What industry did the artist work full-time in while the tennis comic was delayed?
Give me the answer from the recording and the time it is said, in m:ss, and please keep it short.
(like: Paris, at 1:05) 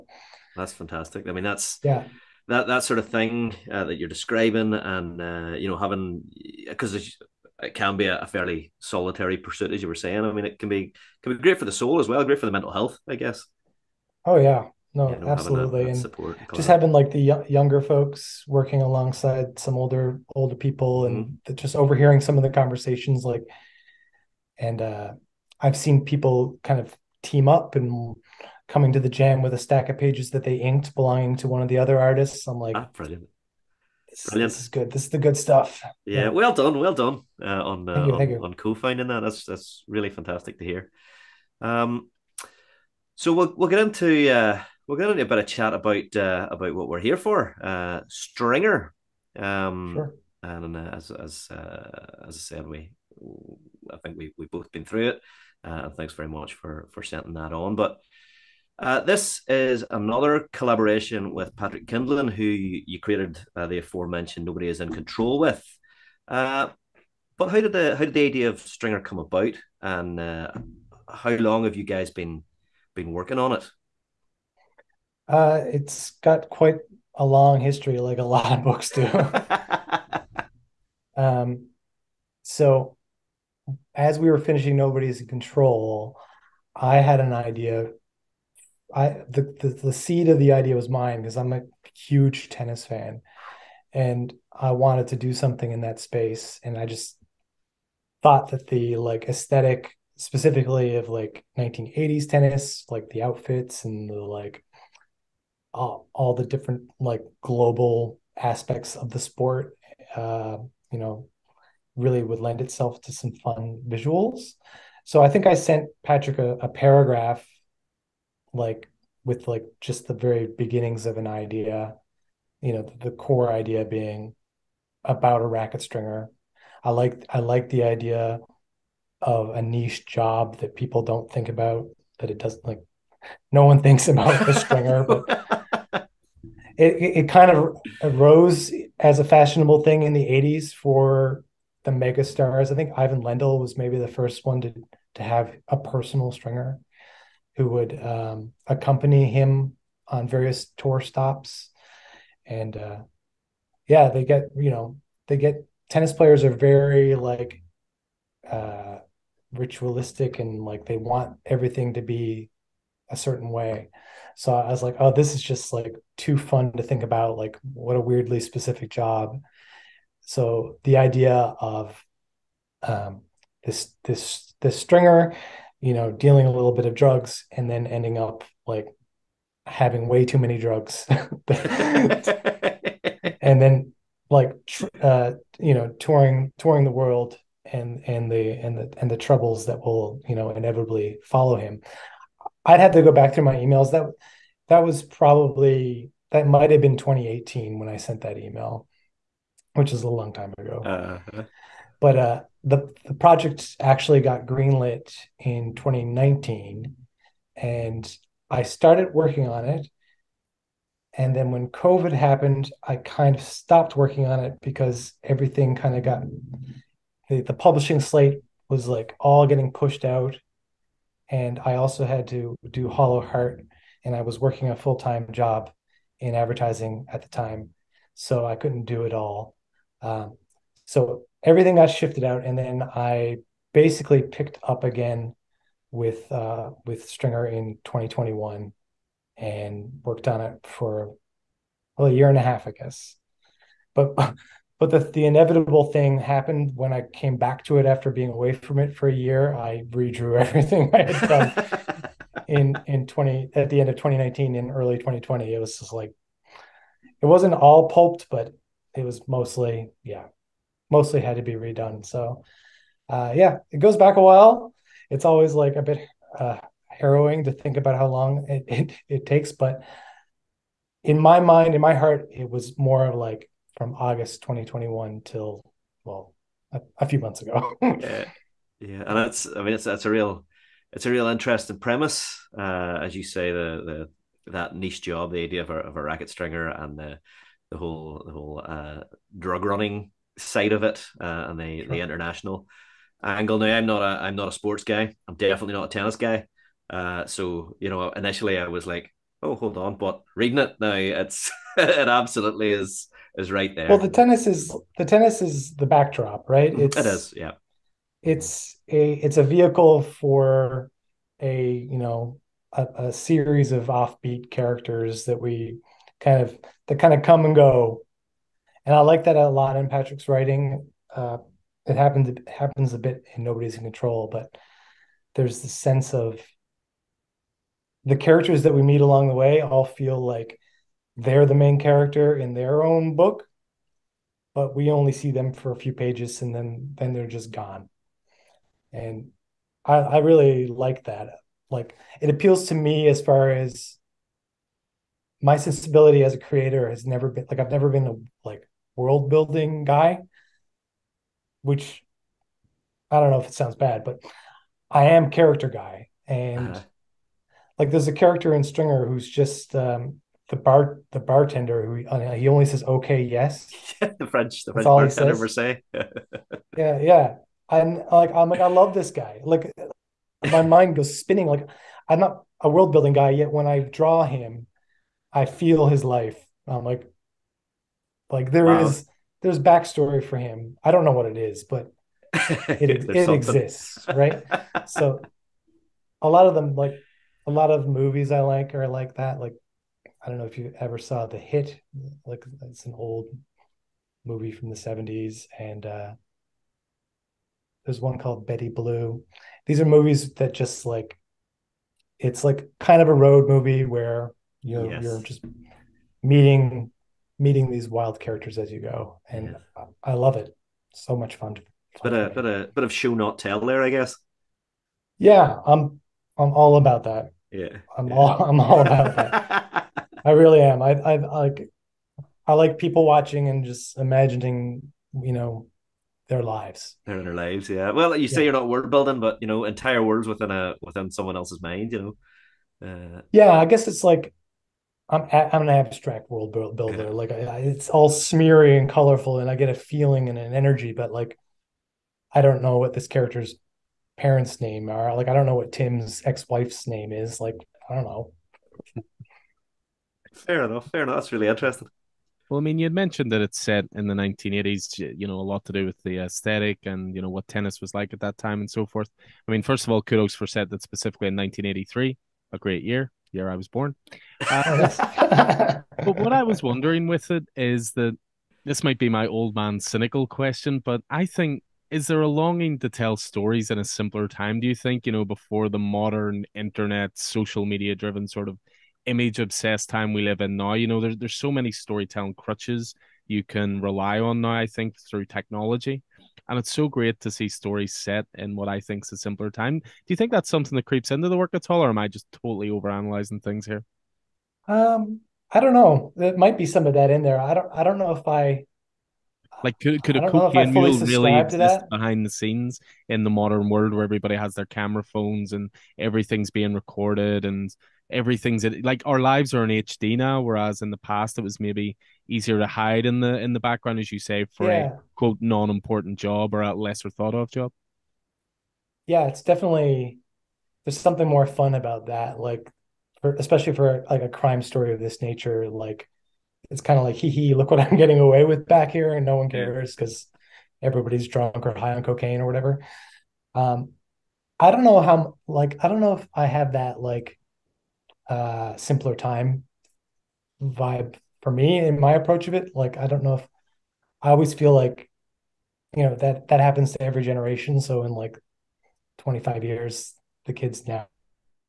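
advertising, at 3:46.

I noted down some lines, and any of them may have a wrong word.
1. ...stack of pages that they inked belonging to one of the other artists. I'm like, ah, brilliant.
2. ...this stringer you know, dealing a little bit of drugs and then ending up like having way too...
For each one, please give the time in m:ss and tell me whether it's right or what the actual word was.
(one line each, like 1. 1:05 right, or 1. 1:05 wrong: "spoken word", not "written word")
1. 0:29 right
2. 2:54 right.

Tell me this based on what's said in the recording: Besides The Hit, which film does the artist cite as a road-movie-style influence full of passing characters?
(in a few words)
Betty Blue.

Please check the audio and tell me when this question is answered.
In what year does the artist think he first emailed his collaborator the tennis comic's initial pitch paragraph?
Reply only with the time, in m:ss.
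3:16.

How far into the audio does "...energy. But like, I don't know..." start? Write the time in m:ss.
7:20.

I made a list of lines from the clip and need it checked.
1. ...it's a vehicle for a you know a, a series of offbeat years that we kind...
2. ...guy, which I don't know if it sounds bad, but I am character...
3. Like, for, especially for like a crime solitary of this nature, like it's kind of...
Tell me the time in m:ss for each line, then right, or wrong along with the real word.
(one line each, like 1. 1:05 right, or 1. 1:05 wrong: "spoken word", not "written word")
1. 5:09 wrong: "characters", not "years"
2. 5:49 right
3. 8:42 wrong: "story", not "solitary".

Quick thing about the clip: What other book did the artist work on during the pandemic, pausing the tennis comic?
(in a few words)
Hollow Heart.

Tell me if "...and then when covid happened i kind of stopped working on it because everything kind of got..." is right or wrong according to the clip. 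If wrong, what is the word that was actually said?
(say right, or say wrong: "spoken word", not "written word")
right.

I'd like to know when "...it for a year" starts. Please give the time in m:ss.
4:08.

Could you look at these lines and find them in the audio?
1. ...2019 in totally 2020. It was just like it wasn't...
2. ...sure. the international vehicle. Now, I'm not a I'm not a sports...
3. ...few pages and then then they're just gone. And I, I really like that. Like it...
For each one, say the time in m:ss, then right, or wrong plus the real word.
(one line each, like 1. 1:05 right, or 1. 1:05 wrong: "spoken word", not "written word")
1. 4:13 wrong: "early", not "totally"
2. 4:51 wrong: "angle", not "vehicle"
3. 5:35 right.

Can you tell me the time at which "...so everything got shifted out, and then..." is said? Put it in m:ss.
3:50.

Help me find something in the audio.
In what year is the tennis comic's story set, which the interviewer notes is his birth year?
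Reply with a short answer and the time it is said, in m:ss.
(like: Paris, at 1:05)
1983, at 7:41.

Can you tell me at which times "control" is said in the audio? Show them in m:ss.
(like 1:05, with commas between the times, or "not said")
1:04, 1:25, 5:23.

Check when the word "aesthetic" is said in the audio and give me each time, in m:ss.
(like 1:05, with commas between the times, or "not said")
1:39, 7:36.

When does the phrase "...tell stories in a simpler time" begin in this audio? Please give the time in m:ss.
7:52.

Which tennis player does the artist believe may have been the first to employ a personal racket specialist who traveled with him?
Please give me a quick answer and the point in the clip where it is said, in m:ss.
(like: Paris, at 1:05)
Ivan Lendl, at 2:22.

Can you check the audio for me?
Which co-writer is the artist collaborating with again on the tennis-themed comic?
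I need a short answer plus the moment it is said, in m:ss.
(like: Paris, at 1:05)
Patrick Kindlon, at 1:01.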